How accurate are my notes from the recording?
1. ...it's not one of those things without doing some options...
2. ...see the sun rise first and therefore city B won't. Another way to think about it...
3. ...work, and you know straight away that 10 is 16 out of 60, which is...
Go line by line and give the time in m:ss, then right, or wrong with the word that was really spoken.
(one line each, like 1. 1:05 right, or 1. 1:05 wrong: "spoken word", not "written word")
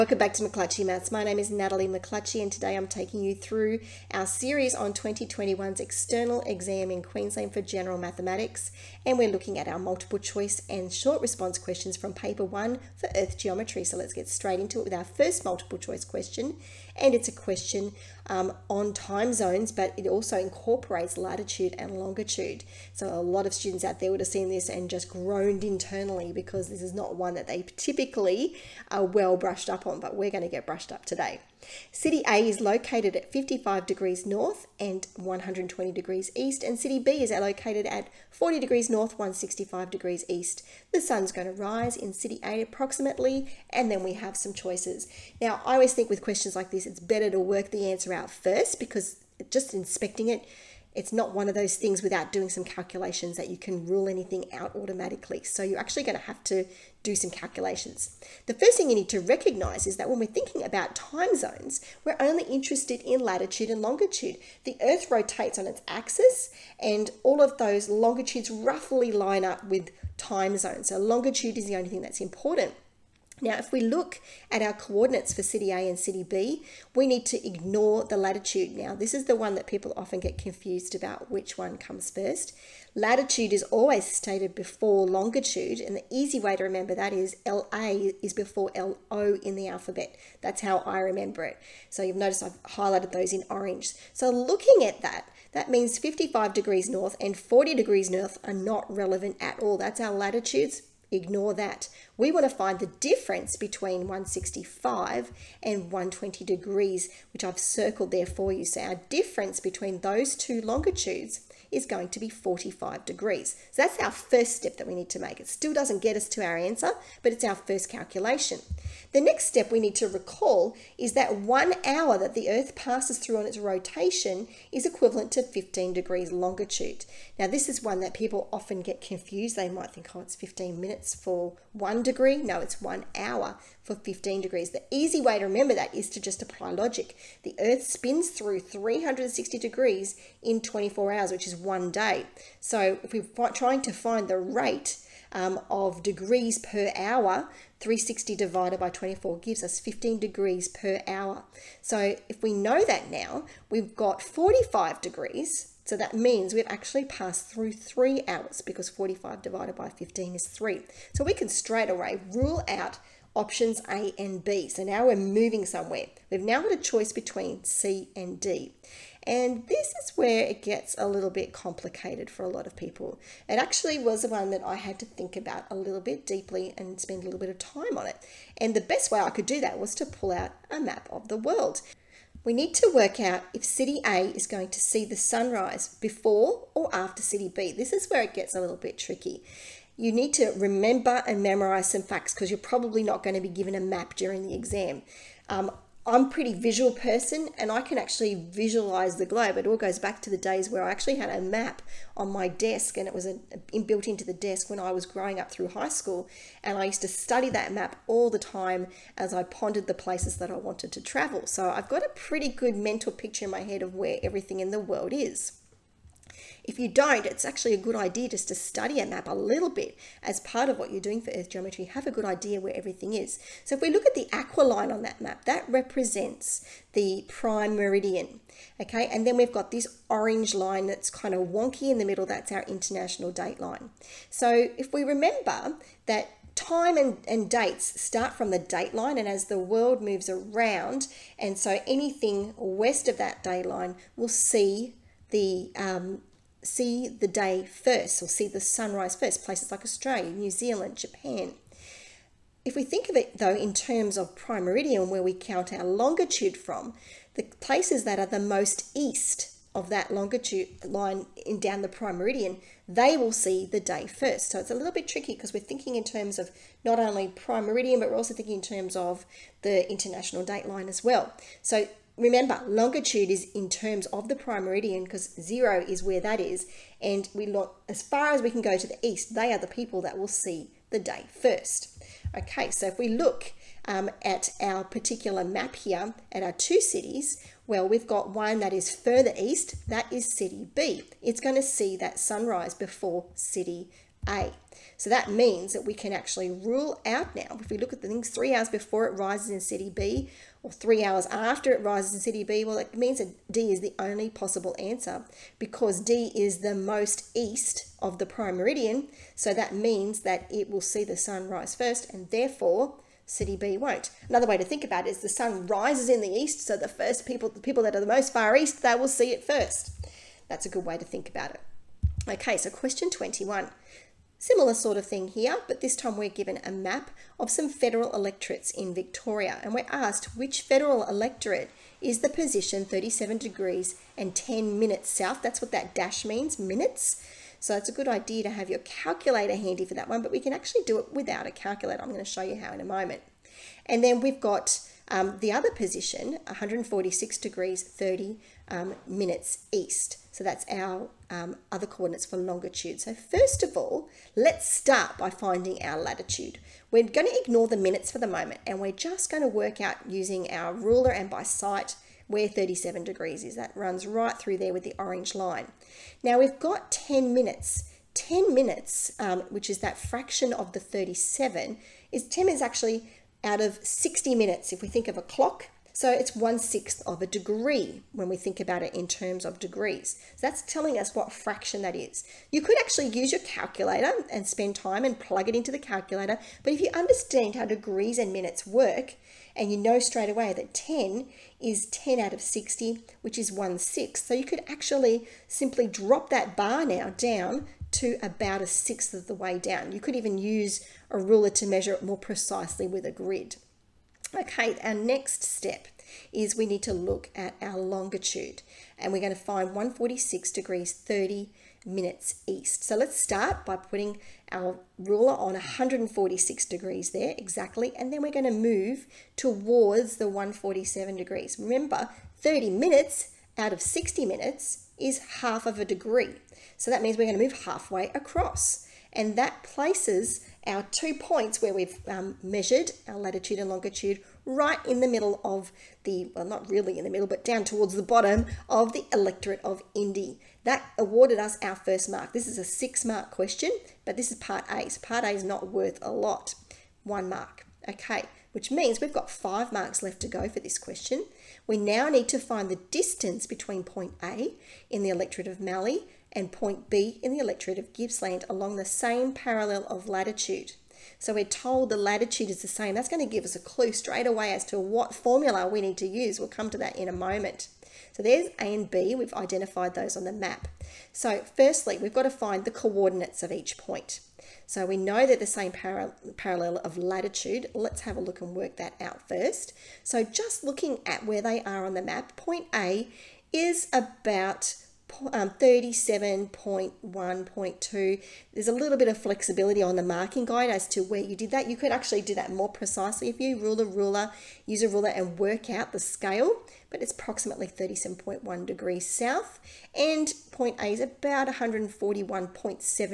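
1. 0:50 wrong: "calculations", not "options"
2. 5:10 right
3. 6:28 wrong: "10", not "16".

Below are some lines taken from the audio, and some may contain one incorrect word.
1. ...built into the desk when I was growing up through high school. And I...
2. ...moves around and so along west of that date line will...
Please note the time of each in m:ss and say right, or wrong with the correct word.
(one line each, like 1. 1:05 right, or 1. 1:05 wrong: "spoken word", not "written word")
1. 3:23 right
2. 4:00 wrong: "anything", not "along".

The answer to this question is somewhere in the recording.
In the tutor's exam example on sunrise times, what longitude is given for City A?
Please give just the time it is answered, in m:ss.
0:35.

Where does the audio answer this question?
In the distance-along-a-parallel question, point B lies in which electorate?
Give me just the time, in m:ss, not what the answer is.
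7:37.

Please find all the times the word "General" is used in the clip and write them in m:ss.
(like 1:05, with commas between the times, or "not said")
0:07.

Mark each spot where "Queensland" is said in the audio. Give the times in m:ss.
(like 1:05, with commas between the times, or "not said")
0:07.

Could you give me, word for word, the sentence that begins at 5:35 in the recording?
That's what that dash means, minutes.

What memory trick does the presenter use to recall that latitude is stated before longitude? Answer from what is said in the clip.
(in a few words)
LA is before LO.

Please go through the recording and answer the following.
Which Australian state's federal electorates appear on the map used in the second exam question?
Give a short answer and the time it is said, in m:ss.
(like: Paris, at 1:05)
Victoria, at 5:28.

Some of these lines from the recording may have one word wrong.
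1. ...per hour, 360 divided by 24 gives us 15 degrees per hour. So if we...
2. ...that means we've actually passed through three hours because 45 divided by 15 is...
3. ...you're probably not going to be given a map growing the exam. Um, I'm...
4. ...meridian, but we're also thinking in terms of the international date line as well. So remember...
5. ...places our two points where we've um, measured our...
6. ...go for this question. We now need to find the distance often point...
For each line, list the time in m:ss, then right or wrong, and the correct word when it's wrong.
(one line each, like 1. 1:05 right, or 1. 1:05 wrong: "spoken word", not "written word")
1. 2:26 right
2. 2:35 right
3. 3:12 wrong: "during", not "growing"
4. 4:27 right
5. 7:09 right
6. 7:30 wrong: "between", not "often".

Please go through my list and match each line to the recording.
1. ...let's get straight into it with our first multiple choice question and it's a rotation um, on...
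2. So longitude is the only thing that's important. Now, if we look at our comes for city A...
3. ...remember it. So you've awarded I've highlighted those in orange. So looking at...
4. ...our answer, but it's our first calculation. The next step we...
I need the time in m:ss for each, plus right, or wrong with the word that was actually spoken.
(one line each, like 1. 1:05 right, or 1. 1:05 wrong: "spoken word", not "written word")
1. 0:13 wrong: "question", not "rotation"
2. 1:10 wrong: "coordinates", not "comes"
3. 1:30 wrong: "noticed", not "awarded"
4. 1:56 right.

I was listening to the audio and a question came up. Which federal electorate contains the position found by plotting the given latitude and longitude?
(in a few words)
Indi.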